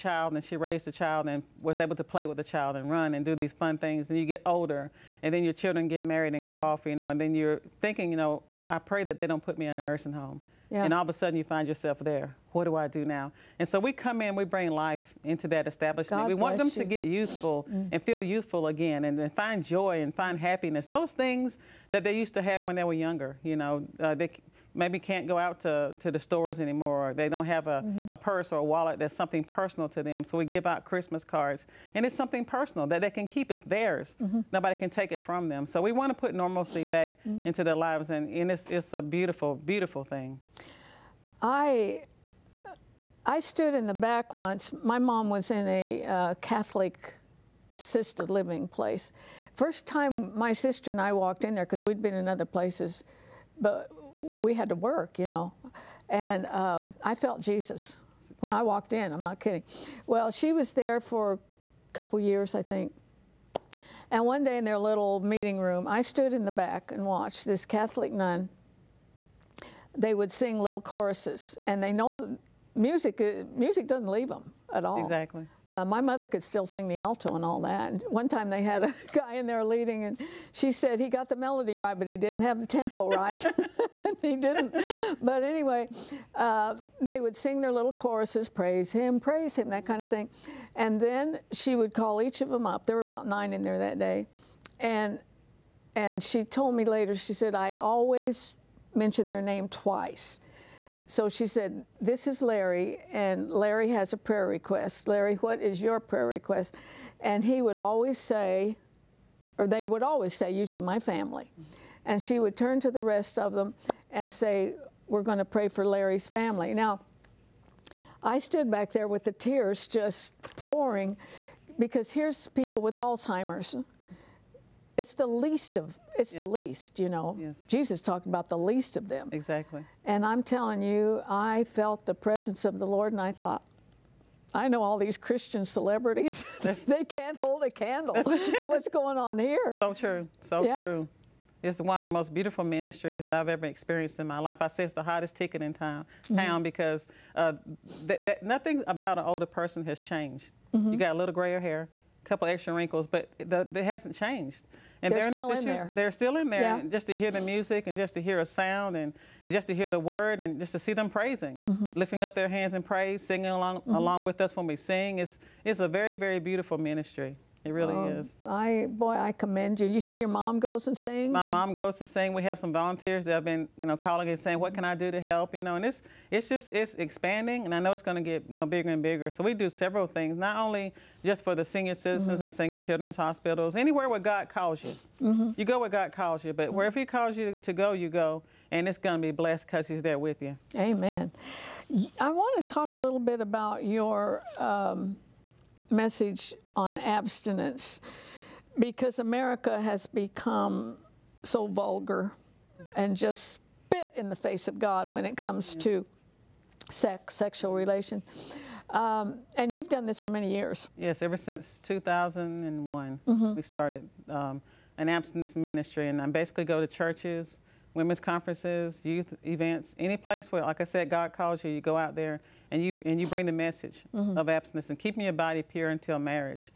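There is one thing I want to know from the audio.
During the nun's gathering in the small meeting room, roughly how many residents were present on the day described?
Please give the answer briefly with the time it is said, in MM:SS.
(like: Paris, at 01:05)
9, at 01:33.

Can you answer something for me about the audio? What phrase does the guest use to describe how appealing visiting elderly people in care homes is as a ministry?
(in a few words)
hottest ticket in town.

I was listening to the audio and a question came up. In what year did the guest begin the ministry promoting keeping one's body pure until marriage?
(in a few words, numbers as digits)
2001.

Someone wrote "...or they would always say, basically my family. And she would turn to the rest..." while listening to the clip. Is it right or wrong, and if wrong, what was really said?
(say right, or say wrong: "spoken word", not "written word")
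wrong: "usually", not "basically".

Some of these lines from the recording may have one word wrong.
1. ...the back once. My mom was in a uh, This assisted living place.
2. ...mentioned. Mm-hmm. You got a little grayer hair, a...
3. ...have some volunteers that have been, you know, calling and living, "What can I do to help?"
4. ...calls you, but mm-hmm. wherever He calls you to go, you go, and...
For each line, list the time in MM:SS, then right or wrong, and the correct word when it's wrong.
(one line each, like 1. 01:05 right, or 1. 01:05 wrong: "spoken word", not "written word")
1. 00:43 wrong: "Catholic", not "This"
2. 02:30 wrong: "changed", not "mentioned"
3. 02:52 wrong: "saying", not "living"
4. 03:06 right.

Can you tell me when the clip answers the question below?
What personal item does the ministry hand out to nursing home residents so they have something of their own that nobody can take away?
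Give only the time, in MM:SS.
00:30.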